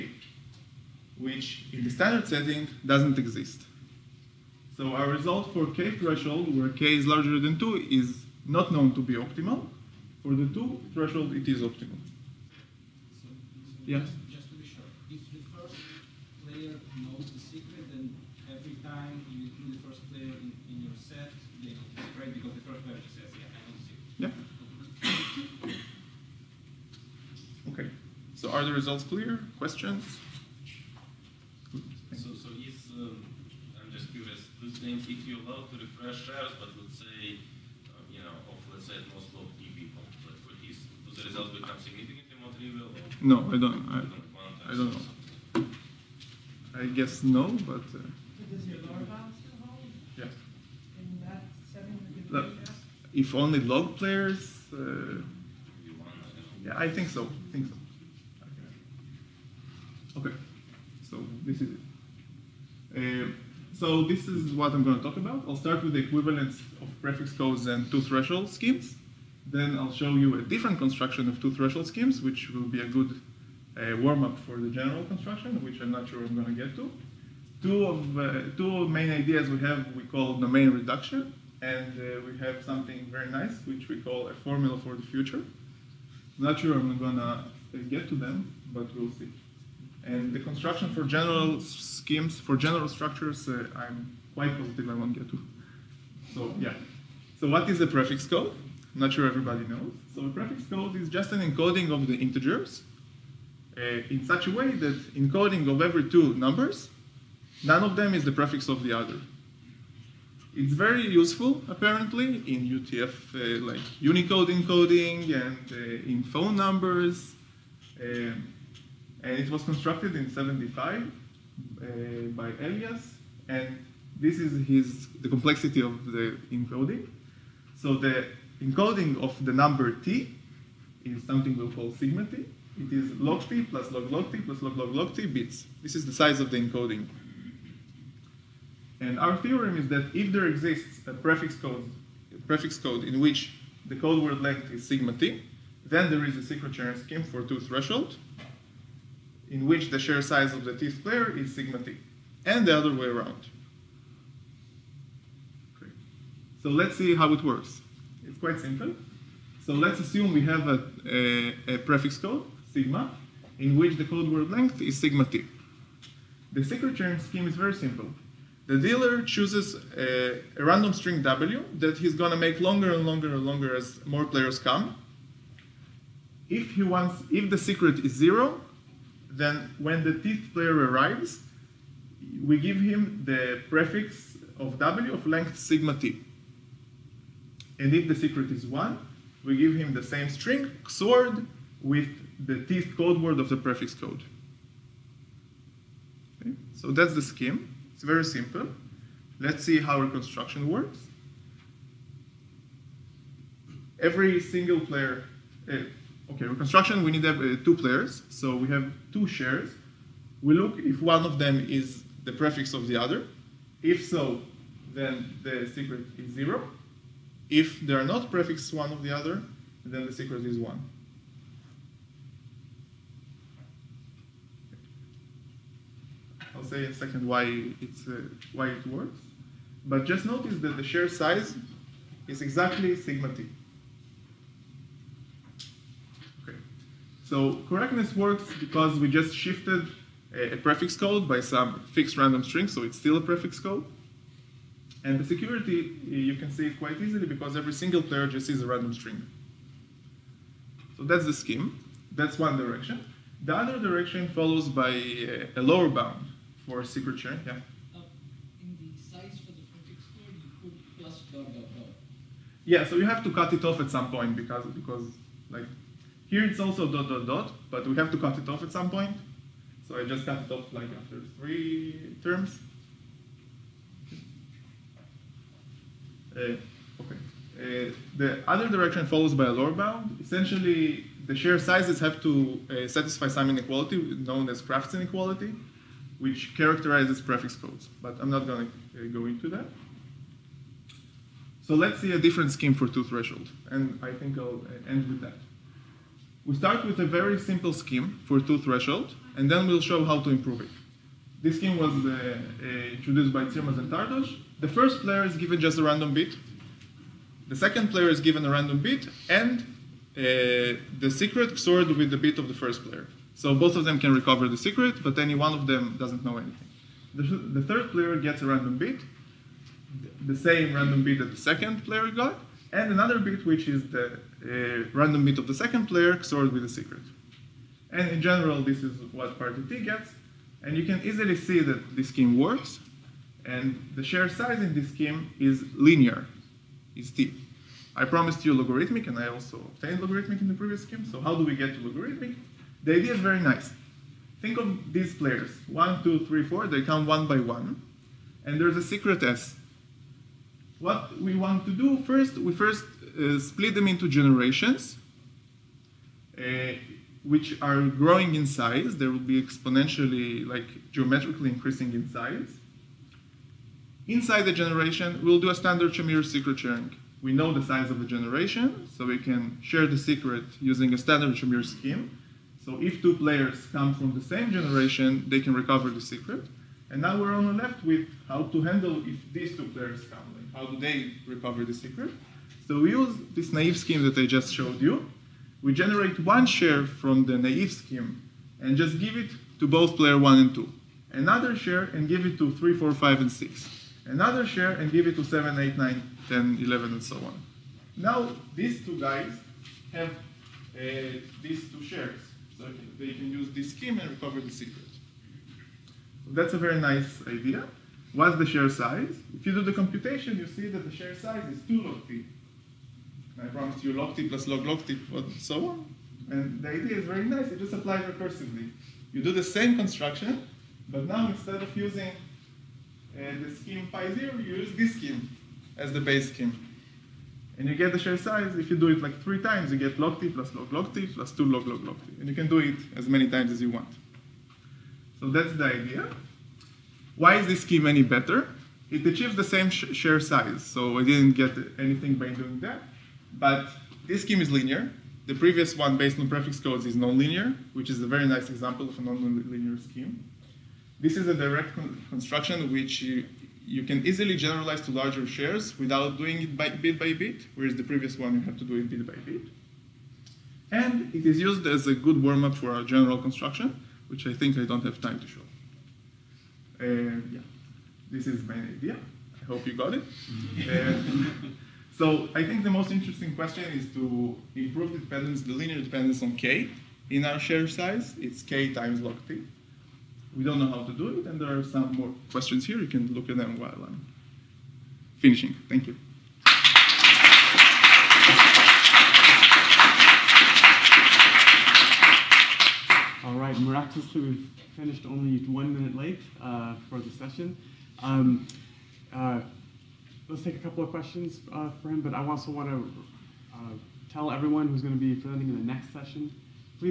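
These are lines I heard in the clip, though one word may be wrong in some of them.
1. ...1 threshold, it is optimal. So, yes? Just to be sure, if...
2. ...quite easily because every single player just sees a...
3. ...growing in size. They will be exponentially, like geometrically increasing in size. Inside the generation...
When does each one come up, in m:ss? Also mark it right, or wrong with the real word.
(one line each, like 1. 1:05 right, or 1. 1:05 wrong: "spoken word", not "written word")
1. 0:10 wrong: "2", not "1"
2. 4:06 right
3. 5:57 right.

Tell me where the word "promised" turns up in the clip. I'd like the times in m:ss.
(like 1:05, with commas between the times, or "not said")
5:38, 6:53.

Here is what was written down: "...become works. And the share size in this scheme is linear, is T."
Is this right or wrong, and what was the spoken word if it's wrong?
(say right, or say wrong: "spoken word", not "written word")
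wrong: "scheme", not "become".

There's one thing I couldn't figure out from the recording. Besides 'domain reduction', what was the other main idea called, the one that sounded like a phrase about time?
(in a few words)
formula for the future.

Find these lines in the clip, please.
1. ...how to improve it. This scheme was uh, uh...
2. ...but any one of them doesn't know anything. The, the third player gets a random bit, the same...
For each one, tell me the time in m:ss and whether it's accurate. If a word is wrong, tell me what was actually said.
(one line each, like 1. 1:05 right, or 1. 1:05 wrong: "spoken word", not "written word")
1. 5:00 right
2. 5:15 right.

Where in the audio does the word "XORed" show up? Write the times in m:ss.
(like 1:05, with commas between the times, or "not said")
3:10, 5:11, 5:26.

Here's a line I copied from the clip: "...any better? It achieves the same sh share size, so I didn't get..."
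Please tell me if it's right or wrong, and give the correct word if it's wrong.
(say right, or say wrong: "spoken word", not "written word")
right.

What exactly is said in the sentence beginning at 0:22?
Because the first player says, yeah, I know the secret.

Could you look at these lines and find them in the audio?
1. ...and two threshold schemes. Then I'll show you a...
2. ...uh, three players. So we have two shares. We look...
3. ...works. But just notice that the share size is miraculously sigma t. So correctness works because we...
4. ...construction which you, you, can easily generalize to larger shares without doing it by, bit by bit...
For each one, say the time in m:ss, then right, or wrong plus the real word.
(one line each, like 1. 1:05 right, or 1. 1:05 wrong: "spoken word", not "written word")
1. 1:07 right
2. 3:27 wrong: "two", not "three"
3. 3:48 wrong: "exactly", not "miraculously"
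4. 7:32 right.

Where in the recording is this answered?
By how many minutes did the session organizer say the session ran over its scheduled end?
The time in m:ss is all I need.
8:15.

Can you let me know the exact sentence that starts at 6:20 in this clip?
Like how do they recover the secret?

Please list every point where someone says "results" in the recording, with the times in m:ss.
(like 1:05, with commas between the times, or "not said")
0:05, 0:28, 0:41.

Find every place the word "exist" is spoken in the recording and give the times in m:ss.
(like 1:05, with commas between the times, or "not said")
0:03, 2:20.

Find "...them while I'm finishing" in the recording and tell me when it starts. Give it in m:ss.
8:03.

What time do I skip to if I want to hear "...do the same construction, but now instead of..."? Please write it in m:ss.
6:59.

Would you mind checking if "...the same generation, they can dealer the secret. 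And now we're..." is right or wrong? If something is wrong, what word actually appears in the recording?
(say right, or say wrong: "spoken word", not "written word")
wrong: "recover", not "dealer".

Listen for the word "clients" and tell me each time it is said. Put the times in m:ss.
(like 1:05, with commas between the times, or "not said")
not said.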